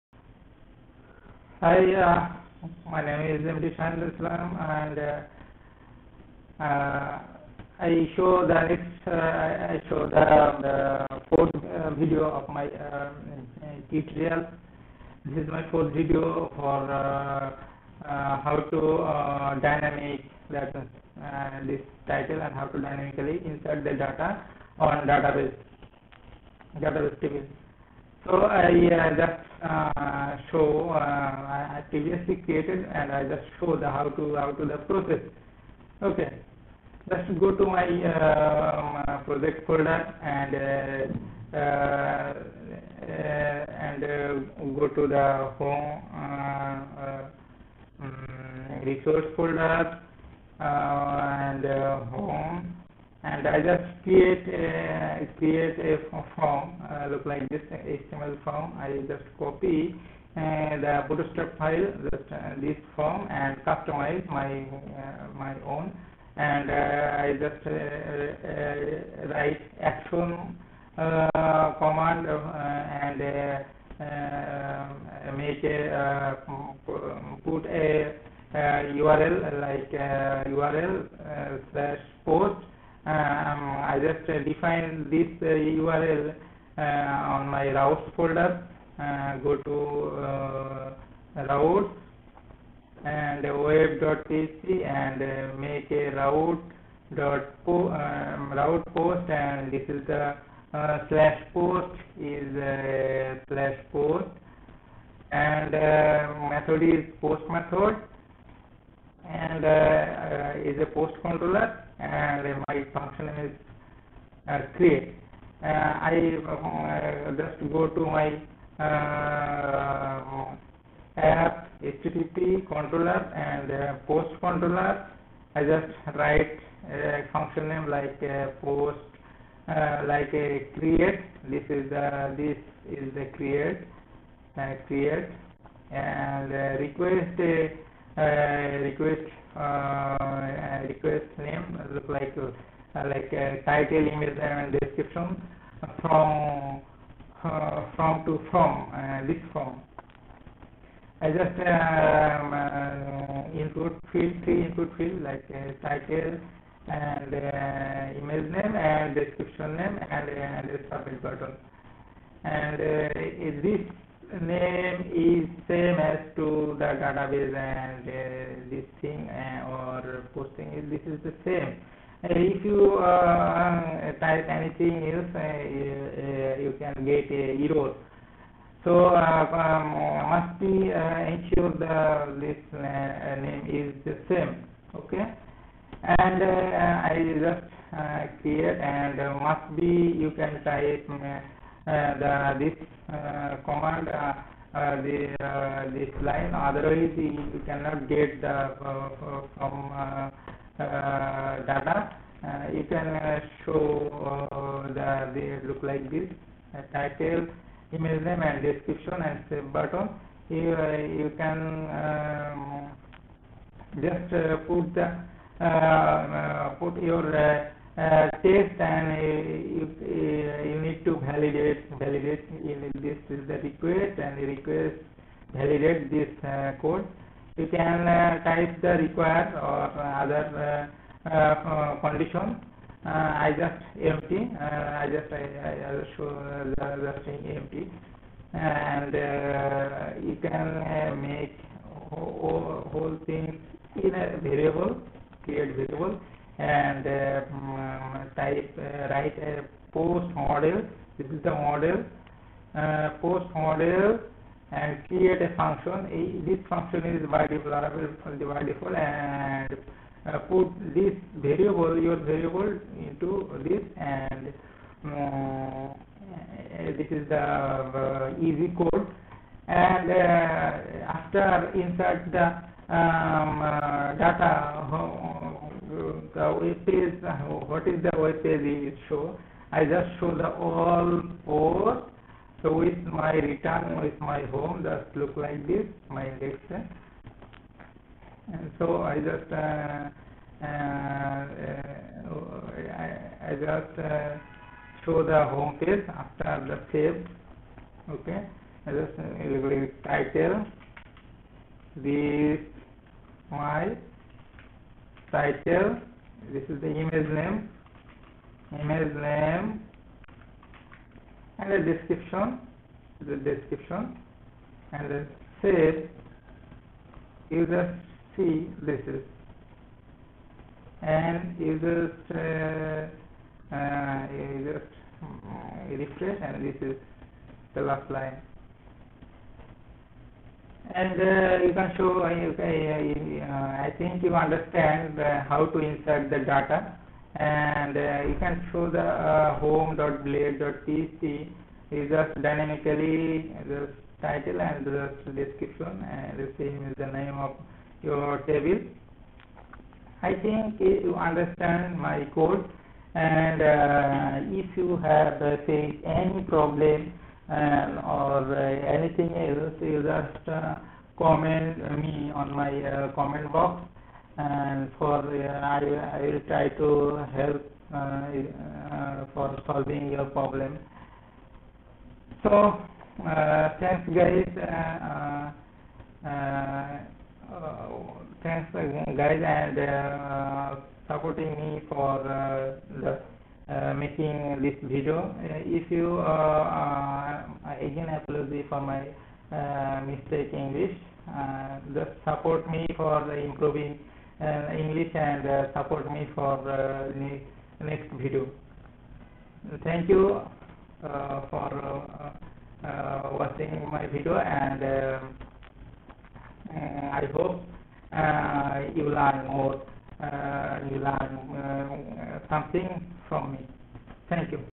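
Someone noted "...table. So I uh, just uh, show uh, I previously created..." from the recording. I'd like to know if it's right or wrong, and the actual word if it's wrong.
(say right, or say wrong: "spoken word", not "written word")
right.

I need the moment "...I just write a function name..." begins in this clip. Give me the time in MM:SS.
02:05.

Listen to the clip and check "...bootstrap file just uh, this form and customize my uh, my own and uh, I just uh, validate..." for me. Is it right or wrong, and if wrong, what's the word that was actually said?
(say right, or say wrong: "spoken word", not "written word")
wrong: "write", not "validate".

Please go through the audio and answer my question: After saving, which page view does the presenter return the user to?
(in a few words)
home page.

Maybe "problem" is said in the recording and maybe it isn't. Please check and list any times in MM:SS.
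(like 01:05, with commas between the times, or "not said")
05:56, 06:10.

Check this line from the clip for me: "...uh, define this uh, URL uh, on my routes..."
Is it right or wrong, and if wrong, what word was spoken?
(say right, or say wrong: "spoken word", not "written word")
right.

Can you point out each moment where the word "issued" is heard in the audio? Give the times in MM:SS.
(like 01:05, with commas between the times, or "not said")
not said.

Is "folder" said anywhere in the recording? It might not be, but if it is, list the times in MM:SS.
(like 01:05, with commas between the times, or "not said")
00:39, 00:49, 01:28.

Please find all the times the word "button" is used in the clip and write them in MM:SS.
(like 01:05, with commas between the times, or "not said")
02:41, 03:29.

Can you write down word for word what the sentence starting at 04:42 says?
So with my return, with my home, just look like this, my index.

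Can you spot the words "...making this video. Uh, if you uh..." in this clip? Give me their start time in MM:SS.
06:23.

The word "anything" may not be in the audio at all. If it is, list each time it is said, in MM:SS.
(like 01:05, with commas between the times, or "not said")
02:54, 05:58.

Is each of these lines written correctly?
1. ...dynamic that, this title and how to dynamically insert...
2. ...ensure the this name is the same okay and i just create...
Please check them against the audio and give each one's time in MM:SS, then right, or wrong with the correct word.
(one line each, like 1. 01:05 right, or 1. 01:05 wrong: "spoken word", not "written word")
1. 00:19 right
2. 03:00 right.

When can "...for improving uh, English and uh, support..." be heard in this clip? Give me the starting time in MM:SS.
06:32.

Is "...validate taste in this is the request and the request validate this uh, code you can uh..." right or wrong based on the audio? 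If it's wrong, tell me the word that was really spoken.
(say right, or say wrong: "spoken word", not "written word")
wrong: "validate", not "taste".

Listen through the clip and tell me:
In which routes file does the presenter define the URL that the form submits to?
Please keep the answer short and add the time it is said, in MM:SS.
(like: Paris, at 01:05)
web.php, at 01:33.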